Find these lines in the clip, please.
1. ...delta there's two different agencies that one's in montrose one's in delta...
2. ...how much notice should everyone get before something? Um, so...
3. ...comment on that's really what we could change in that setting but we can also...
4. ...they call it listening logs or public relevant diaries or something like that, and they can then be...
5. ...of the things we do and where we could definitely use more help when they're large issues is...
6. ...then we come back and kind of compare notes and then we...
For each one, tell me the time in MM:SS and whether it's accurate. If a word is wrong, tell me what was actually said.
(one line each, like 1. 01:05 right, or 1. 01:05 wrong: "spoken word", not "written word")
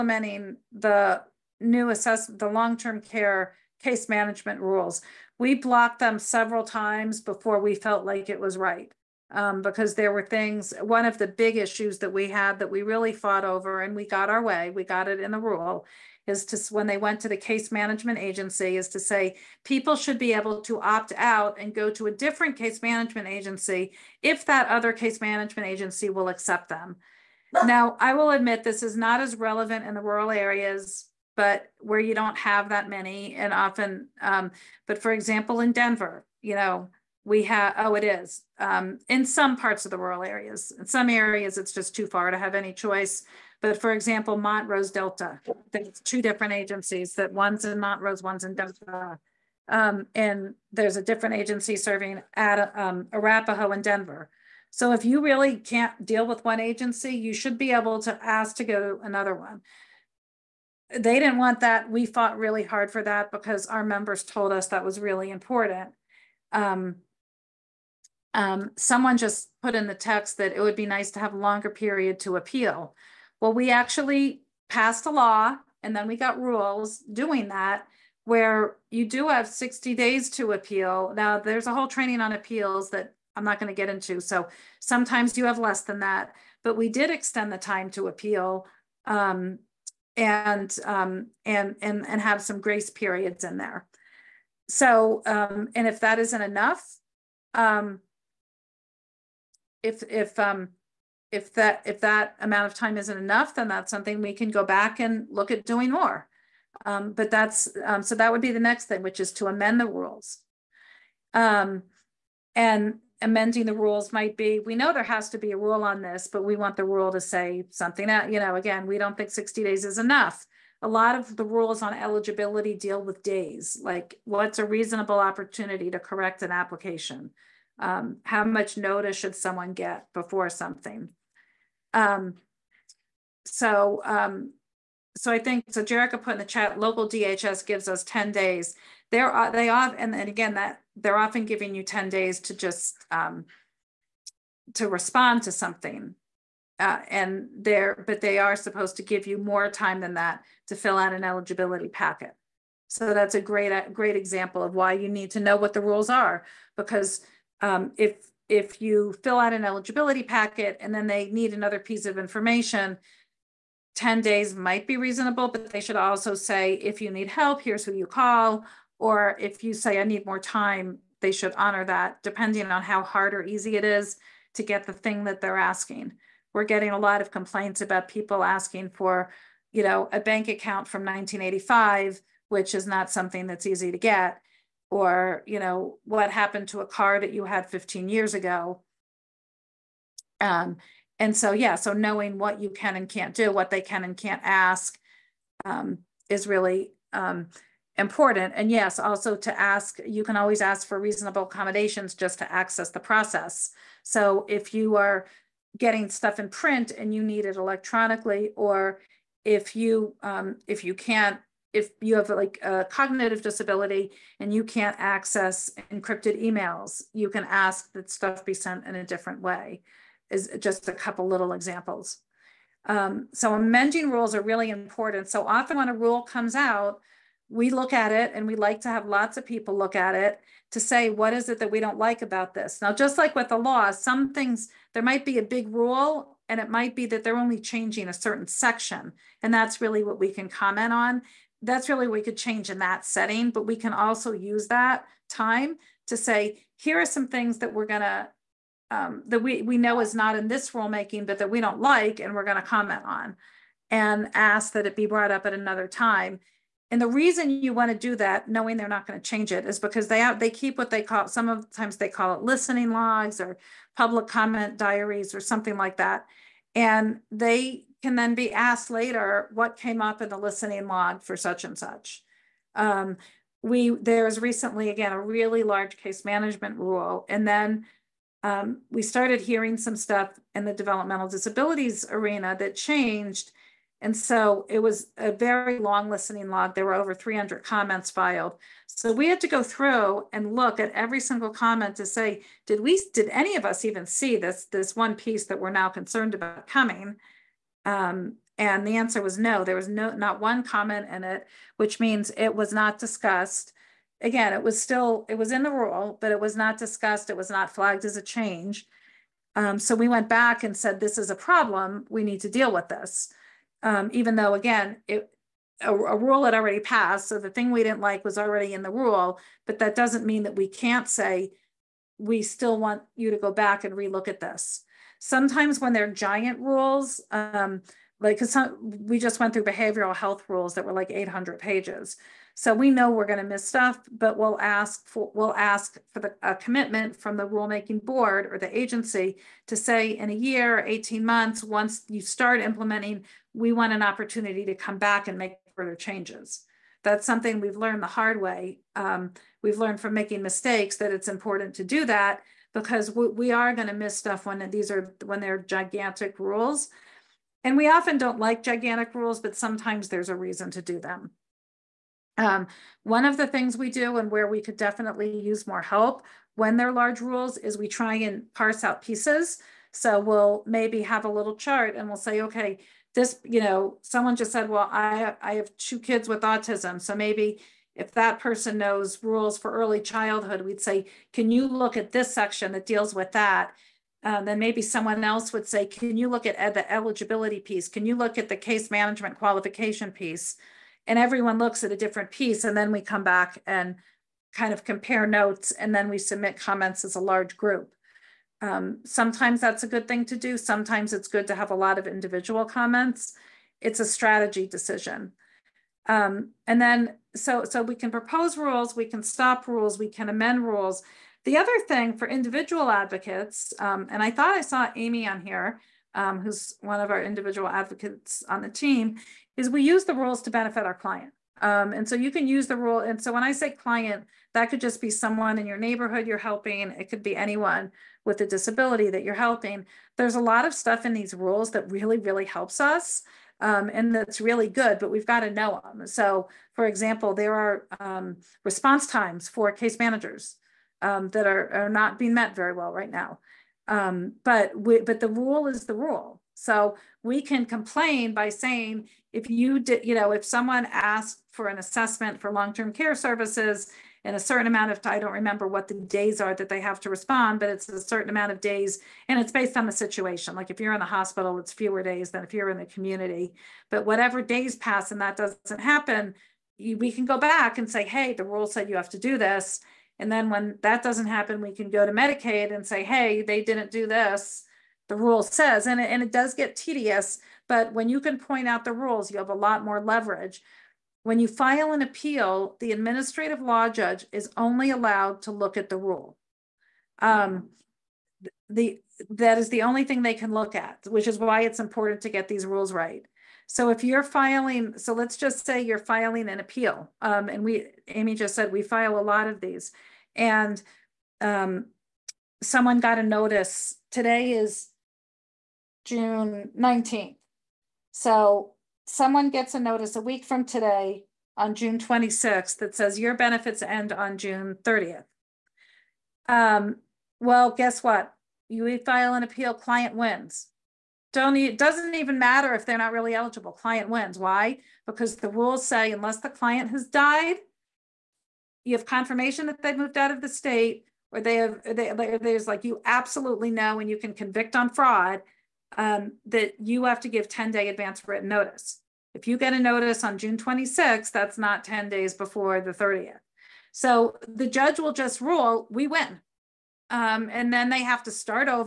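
1. 00:44 right
2. 02:08 wrong: "someone", not "everyone"
3. 04:00 right
4. 04:21 wrong: "comment", not "relevant"
5. 06:03 wrong: "rules", not "issues"
6. 06:32 right.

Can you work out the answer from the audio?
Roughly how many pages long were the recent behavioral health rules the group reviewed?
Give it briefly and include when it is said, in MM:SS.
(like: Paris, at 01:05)
800, at 05:31.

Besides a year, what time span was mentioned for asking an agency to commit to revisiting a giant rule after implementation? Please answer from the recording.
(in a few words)
18 months.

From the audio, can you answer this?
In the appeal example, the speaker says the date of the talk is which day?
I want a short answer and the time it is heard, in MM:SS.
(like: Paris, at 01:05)
June 19th, at 08:26.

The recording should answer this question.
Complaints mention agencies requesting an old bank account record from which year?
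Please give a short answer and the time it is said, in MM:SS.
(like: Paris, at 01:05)
1985, at 03:01.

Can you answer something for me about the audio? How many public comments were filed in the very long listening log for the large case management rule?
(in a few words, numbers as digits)
Over 300.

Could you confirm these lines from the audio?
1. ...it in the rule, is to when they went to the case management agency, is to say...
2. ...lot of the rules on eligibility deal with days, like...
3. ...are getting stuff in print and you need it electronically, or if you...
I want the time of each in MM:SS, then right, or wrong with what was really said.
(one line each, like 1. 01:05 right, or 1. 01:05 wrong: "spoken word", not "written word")
1. 00:15 right
2. 02:00 right
3. 03:24 right.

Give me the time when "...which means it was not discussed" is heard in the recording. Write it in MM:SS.
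05:01.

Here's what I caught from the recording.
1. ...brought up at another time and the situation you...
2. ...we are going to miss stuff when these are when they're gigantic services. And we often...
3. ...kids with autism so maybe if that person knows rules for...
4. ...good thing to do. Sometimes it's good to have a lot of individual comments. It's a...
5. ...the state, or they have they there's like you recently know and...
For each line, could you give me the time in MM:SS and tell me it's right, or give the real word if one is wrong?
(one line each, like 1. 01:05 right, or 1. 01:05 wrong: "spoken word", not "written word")
1. 04:15 wrong: "reason", not "situation"
2. 05:53 wrong: "rules", not "services"
3. 06:15 right
4. 06:39 right
5. 08:50 wrong: "absolutely", not "recently".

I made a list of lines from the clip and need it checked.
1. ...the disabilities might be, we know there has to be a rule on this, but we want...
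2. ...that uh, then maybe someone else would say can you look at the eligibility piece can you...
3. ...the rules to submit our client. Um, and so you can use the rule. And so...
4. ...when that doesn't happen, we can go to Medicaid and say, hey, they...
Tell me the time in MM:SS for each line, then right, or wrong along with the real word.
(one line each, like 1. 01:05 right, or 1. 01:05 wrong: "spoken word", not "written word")
1. 01:53 wrong: "rules", not "disabilities"
2. 06:23 right
3. 07:00 wrong: "benefit", not "submit"
4. 07:50 right.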